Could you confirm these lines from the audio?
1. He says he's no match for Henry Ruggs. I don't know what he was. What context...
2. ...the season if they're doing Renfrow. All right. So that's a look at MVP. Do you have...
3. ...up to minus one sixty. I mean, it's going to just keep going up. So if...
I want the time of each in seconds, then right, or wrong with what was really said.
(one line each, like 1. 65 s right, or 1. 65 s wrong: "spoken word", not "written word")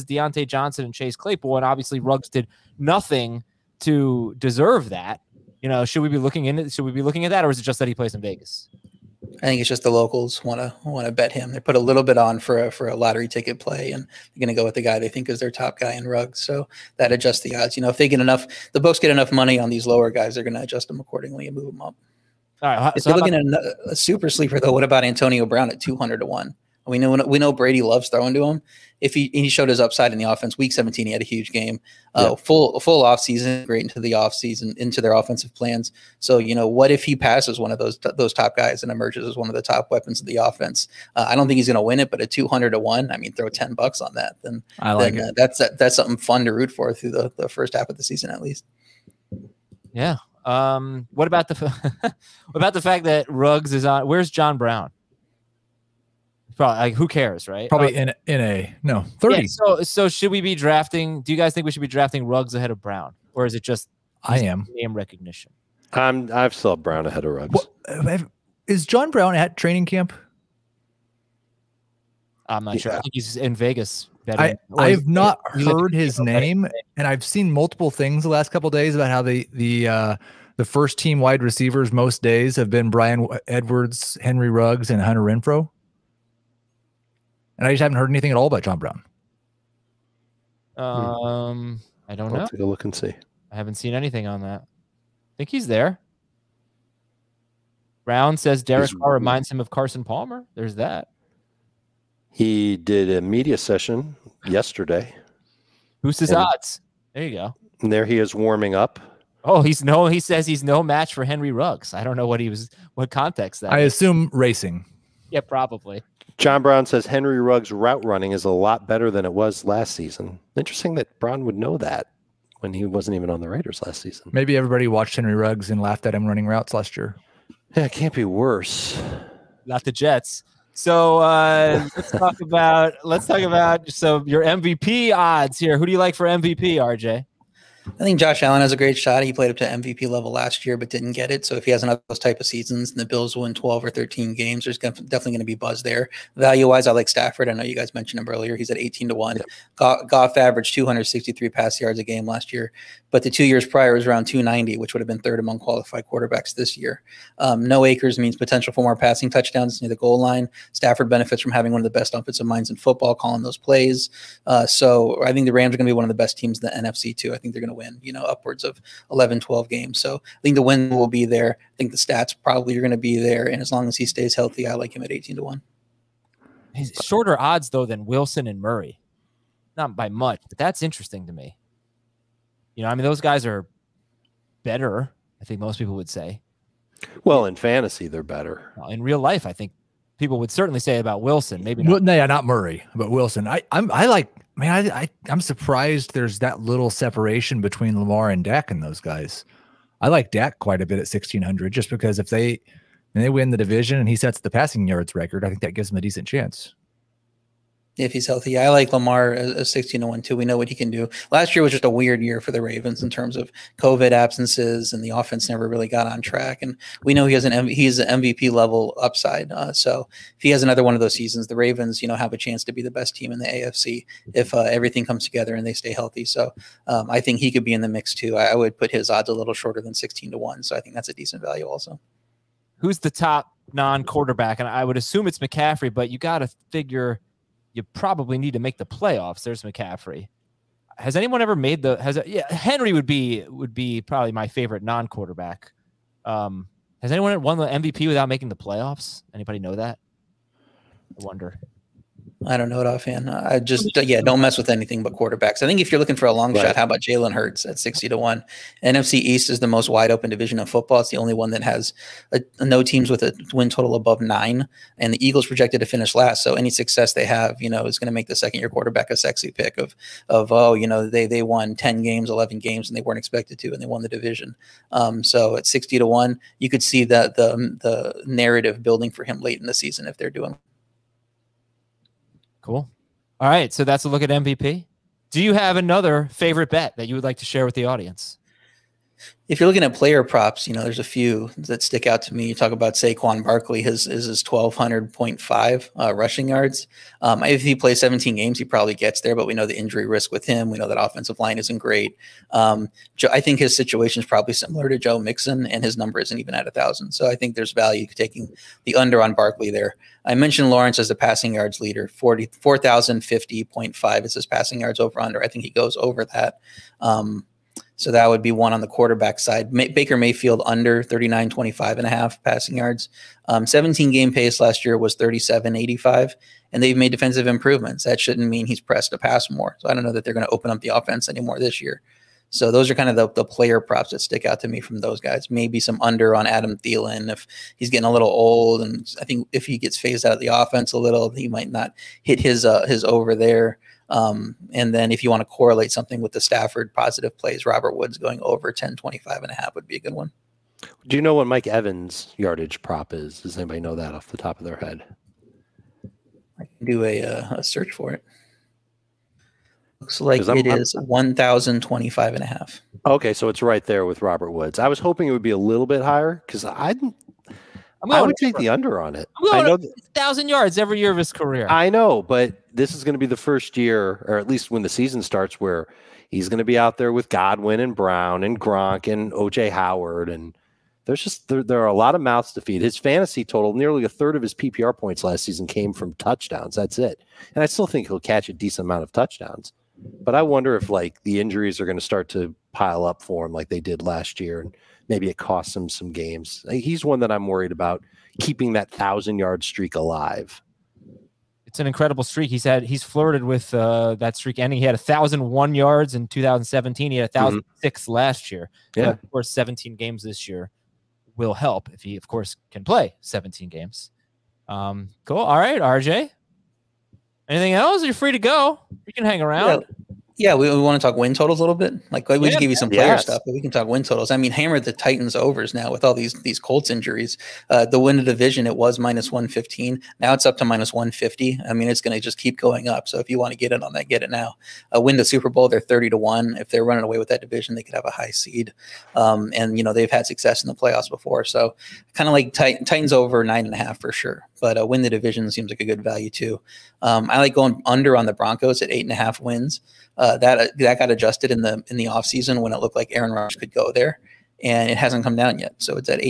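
1. 110 s right
2. 279 s wrong: "Cool", not "Renfrow"
3. 430 s wrong: "fifty", not "sixty".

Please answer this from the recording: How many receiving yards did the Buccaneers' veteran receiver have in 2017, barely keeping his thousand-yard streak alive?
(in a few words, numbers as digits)
1,001.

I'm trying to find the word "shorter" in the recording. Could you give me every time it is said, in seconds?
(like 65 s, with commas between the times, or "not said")
177 s, 229 s.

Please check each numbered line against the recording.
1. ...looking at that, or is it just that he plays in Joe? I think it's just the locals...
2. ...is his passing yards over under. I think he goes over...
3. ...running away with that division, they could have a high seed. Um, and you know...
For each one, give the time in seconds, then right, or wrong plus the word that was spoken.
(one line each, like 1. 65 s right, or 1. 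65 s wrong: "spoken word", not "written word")
1. 7 s wrong: "Vegas", not "Joe"
2. 312 s right
3. 436 s right.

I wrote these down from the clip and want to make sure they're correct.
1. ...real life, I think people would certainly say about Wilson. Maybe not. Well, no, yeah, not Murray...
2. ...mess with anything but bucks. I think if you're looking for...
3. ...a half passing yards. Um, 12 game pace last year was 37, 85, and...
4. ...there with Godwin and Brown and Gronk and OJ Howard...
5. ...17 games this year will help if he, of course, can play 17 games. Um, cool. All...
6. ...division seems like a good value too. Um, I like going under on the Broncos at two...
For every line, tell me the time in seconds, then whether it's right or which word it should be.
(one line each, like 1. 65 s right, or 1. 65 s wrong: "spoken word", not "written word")
1. 189 s right
2. 254 s wrong: "quarterbacks", not "bucks"
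3. 322 s wrong: "17", not "12"
4. 376 s right
5. 409 s right
6. 445 s wrong: "eight", not "two".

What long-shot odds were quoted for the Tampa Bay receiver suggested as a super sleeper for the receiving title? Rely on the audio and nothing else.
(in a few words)
200 to 1.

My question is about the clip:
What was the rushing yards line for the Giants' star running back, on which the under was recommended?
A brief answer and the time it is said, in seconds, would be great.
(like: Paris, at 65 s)
1200.5, at 294 s.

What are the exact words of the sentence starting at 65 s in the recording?
I'm I've saw Brown ahead of Ruggs.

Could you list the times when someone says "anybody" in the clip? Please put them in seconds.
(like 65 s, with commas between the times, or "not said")
249 s, 353 s.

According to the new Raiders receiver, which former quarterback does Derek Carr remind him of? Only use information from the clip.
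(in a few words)
Carson Palmer.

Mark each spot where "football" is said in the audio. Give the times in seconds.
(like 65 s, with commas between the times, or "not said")
162 s, 260 s.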